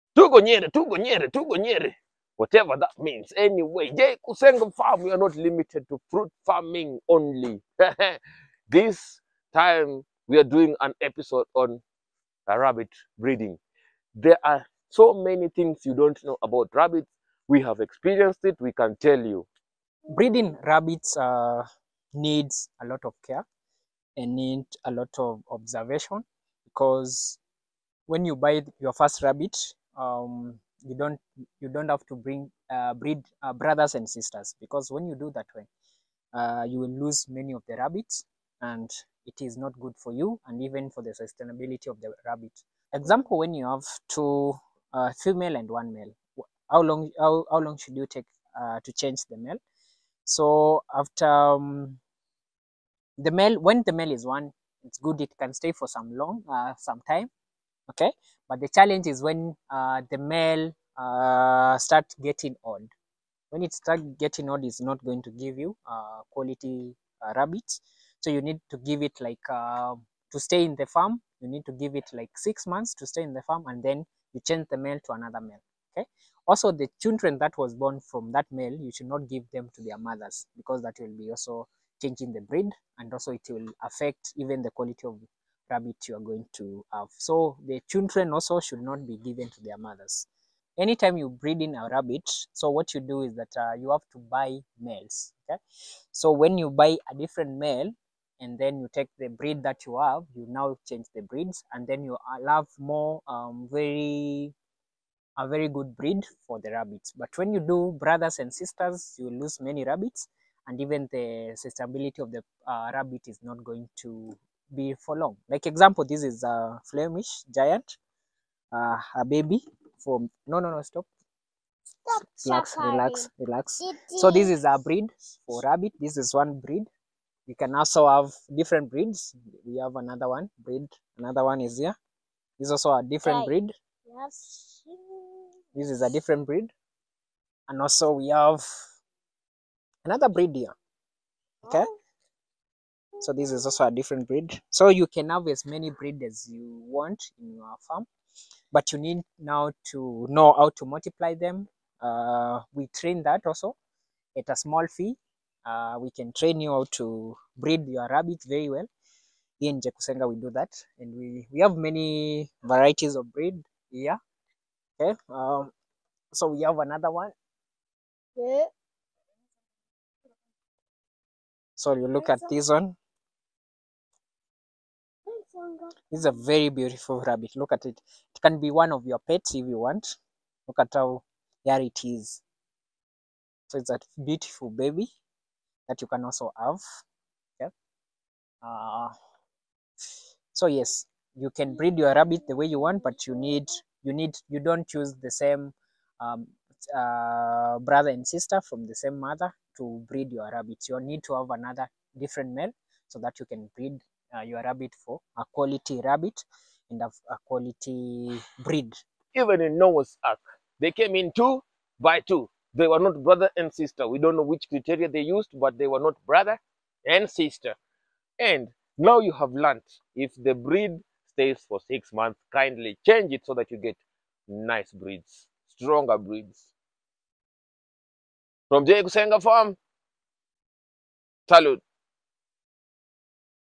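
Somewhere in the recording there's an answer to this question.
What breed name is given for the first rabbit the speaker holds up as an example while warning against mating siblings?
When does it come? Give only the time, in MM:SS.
01:56.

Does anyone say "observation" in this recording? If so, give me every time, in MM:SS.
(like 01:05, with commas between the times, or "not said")
00:25.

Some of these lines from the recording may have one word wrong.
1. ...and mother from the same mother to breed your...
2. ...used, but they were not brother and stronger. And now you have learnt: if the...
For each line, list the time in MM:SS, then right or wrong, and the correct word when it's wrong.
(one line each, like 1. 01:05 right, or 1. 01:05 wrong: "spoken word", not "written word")
1. 03:18 wrong: "sister", not "mother"
2. 03:35 wrong: "sister", not "stronger".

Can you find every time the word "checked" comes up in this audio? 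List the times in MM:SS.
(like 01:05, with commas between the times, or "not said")
not said.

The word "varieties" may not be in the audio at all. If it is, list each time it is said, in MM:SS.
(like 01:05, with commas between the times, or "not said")
02:42.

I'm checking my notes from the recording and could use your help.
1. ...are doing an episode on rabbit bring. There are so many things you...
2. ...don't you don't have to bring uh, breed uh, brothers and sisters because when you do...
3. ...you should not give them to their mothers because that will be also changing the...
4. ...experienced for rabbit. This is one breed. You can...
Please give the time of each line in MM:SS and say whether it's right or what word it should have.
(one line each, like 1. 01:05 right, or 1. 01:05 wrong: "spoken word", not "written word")
1. 00:10 wrong: "breeding", not "bring"
2. 00:30 right
3. 01:18 right
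4. 02:04 wrong: "breed", not "experienced".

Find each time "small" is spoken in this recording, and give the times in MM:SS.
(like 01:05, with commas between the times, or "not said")
02:34.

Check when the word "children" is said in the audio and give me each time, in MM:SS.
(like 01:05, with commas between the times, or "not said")
01:17, 01:27.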